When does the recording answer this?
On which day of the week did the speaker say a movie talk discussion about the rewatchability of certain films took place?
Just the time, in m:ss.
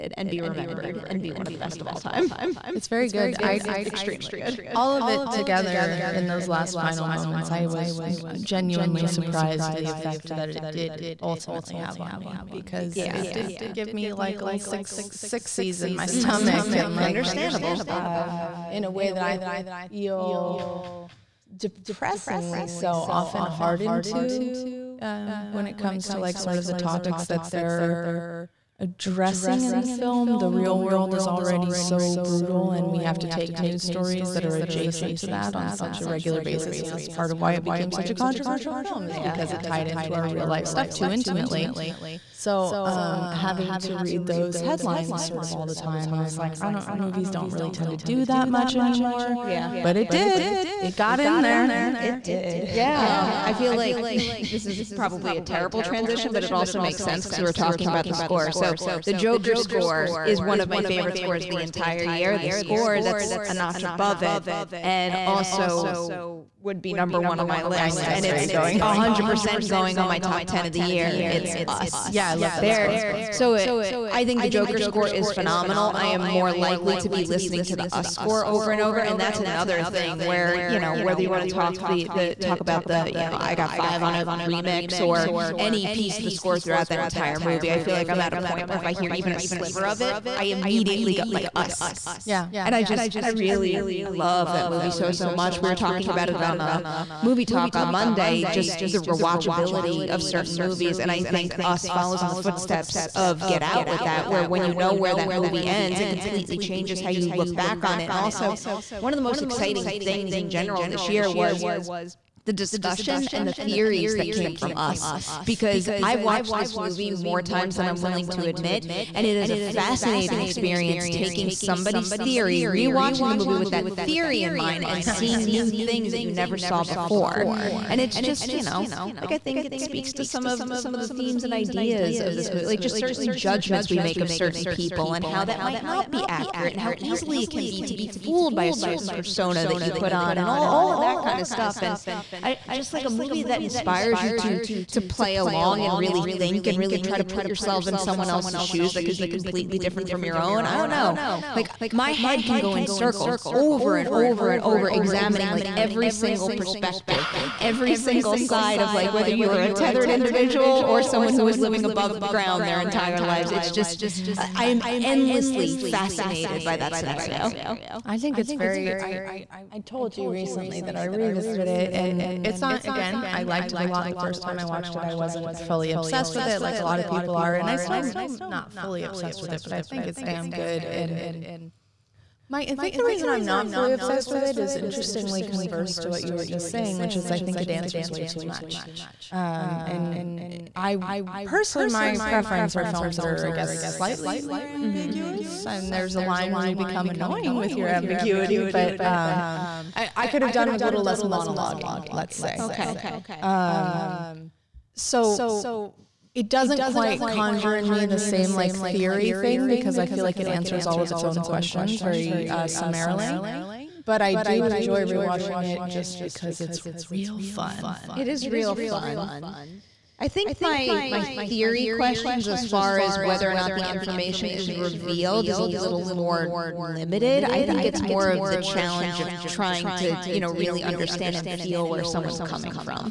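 1:37.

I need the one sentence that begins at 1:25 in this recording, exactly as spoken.
any piece of the score throughout that entire movie.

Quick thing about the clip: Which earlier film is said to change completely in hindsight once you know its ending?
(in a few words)
Get Out.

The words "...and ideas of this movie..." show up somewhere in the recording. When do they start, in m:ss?
2:11.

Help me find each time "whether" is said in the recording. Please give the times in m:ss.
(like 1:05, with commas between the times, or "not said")
1:20, 2:39, 3:43.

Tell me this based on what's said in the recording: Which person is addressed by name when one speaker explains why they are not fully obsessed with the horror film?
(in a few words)
Mike.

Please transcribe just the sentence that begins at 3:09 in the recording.
Um, and I personally, my preference are films that are, I guess, slightly more mm-hmm.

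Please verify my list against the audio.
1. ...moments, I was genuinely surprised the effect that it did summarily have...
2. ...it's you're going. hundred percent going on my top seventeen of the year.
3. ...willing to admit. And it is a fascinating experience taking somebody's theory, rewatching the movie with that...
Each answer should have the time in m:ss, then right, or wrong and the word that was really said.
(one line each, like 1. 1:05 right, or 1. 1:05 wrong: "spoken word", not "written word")
1. 0:07 wrong: "ultimately", not "summarily"
2. 1:08 wrong: "ten", not "seventeen"
3. 1:58 right.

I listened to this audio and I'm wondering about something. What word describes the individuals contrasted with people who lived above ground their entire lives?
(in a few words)
tethered.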